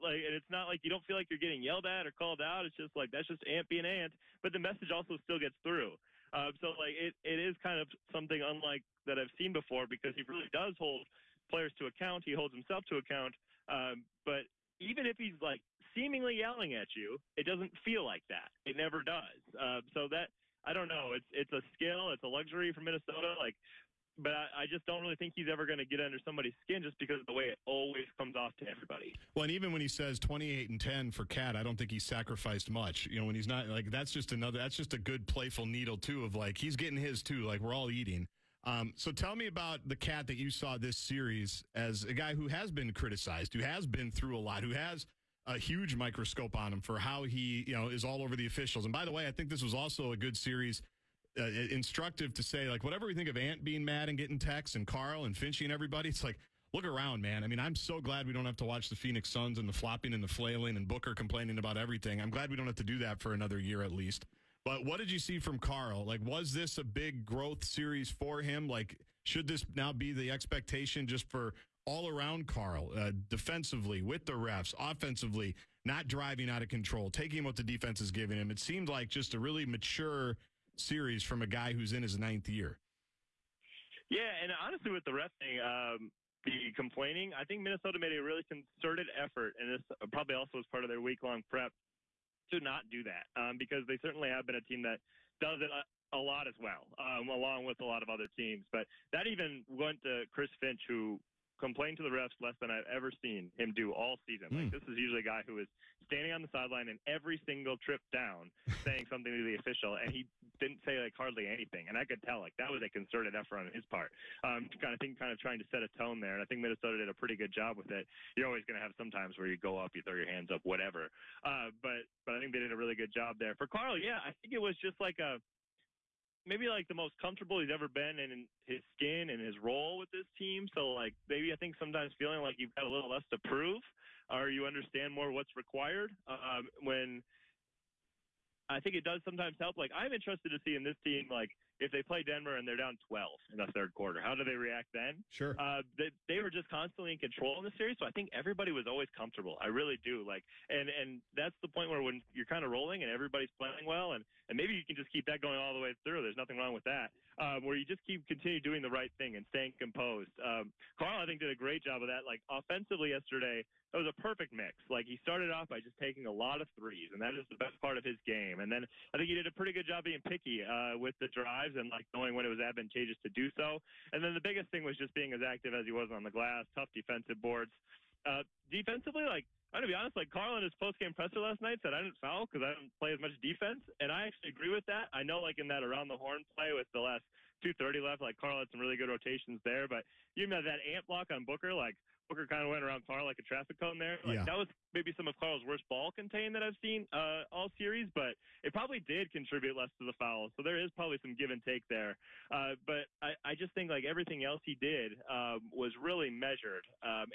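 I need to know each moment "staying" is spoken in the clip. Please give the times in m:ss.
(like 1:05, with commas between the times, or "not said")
2:39.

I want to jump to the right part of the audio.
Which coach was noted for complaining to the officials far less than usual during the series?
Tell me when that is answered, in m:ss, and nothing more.
1:40.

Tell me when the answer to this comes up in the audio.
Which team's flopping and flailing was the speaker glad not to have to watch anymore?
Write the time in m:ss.
0:58.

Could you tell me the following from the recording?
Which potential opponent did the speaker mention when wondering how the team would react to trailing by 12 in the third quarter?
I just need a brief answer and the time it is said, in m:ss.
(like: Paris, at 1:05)
Denver, at 2:22.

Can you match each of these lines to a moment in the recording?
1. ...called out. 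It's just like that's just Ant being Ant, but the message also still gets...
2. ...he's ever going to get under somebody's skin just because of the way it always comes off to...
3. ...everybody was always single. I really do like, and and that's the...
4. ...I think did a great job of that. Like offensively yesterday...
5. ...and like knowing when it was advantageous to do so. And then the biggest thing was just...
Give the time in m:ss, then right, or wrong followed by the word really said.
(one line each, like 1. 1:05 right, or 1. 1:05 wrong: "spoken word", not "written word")
1. 0:02 right
2. 0:25 right
3. 2:28 wrong: "comfortable", not "single"
4. 2:41 right
5. 2:51 right.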